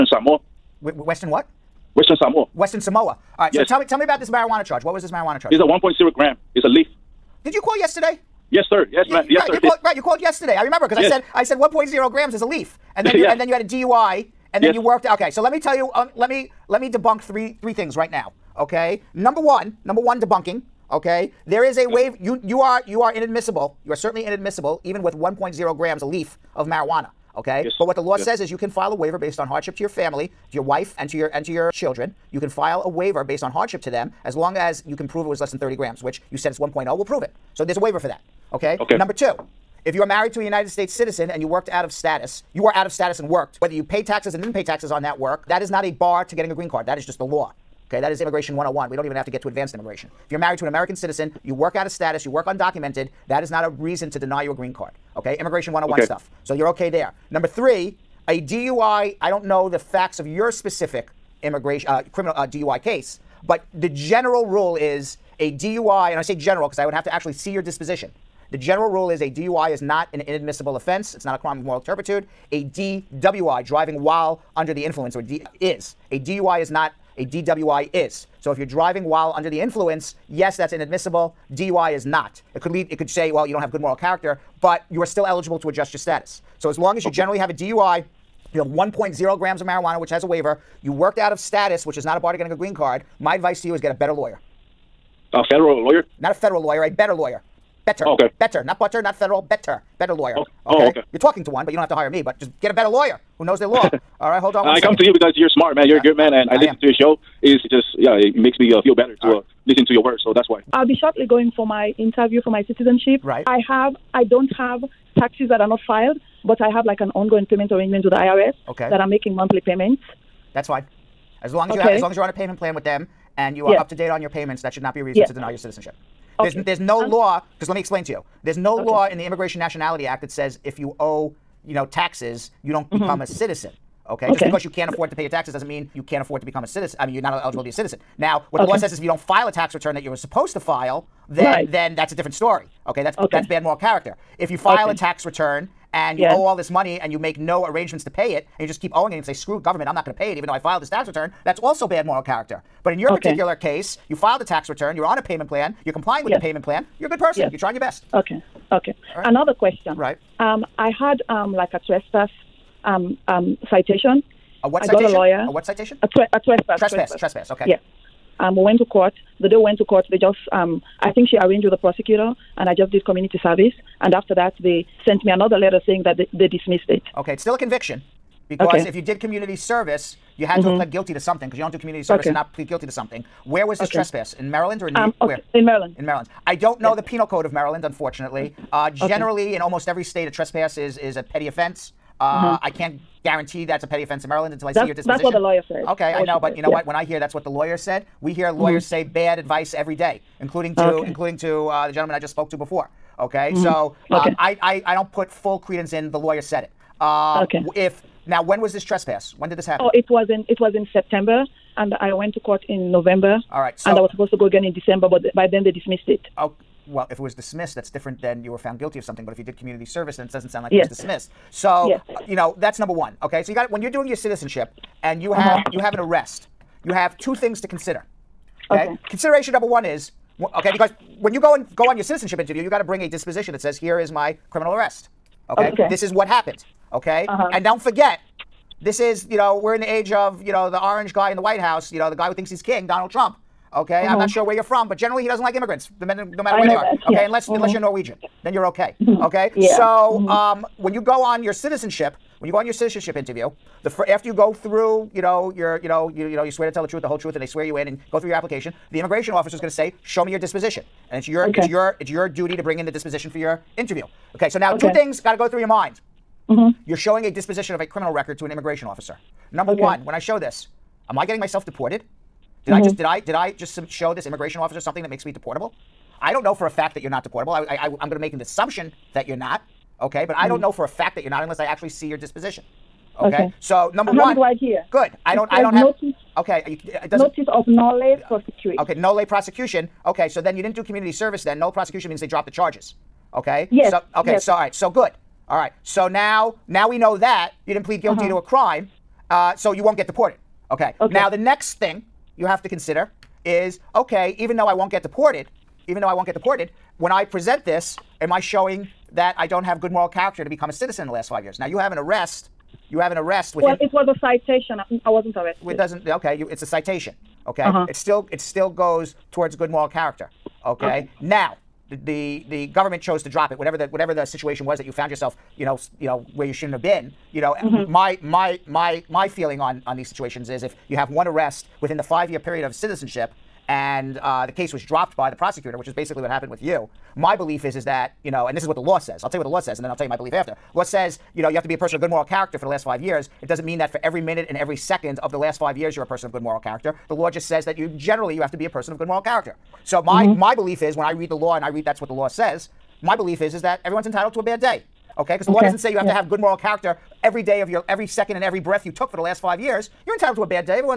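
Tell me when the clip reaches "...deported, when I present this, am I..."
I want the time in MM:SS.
05:06.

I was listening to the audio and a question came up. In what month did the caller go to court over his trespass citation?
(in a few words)
November.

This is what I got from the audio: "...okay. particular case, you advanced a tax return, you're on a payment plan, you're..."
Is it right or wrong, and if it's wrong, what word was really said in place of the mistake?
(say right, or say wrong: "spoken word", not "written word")
wrong: "filed", not "advanced".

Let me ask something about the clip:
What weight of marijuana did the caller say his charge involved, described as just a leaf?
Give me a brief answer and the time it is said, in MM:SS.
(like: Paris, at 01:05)
1.0 gram, at 00:05.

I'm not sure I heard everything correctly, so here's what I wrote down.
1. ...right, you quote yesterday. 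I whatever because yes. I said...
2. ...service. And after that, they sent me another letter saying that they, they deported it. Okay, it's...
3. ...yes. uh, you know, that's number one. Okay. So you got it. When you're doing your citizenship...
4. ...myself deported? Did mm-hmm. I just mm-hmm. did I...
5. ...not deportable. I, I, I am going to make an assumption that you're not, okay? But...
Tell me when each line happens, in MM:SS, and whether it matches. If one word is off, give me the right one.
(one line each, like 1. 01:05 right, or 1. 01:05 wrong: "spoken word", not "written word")
1. 00:09 wrong: "remember", not "whatever"
2. 02:53 wrong: "dismissed", not "deported"
3. 03:41 right
4. 04:31 right
5. 04:37 right.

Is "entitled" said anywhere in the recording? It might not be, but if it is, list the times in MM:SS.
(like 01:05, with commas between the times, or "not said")
05:54, 06:00.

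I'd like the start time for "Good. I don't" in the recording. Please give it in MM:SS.
04:44.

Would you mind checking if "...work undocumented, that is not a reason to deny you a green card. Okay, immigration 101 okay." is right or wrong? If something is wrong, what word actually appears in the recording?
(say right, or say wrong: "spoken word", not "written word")
right.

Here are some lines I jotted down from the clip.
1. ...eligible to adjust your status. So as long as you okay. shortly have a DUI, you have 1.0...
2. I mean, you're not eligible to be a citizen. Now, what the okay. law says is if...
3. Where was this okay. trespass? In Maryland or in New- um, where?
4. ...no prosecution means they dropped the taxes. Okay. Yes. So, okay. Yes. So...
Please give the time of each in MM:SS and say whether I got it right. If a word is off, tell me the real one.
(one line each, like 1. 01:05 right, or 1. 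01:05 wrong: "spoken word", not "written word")
1. 01:25 wrong: "generally", not "shortly"
2. 02:16 right
3. 03:03 right
4. 04:51 wrong: "charges", not "taxes".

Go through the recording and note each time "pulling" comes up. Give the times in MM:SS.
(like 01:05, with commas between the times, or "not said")
not said.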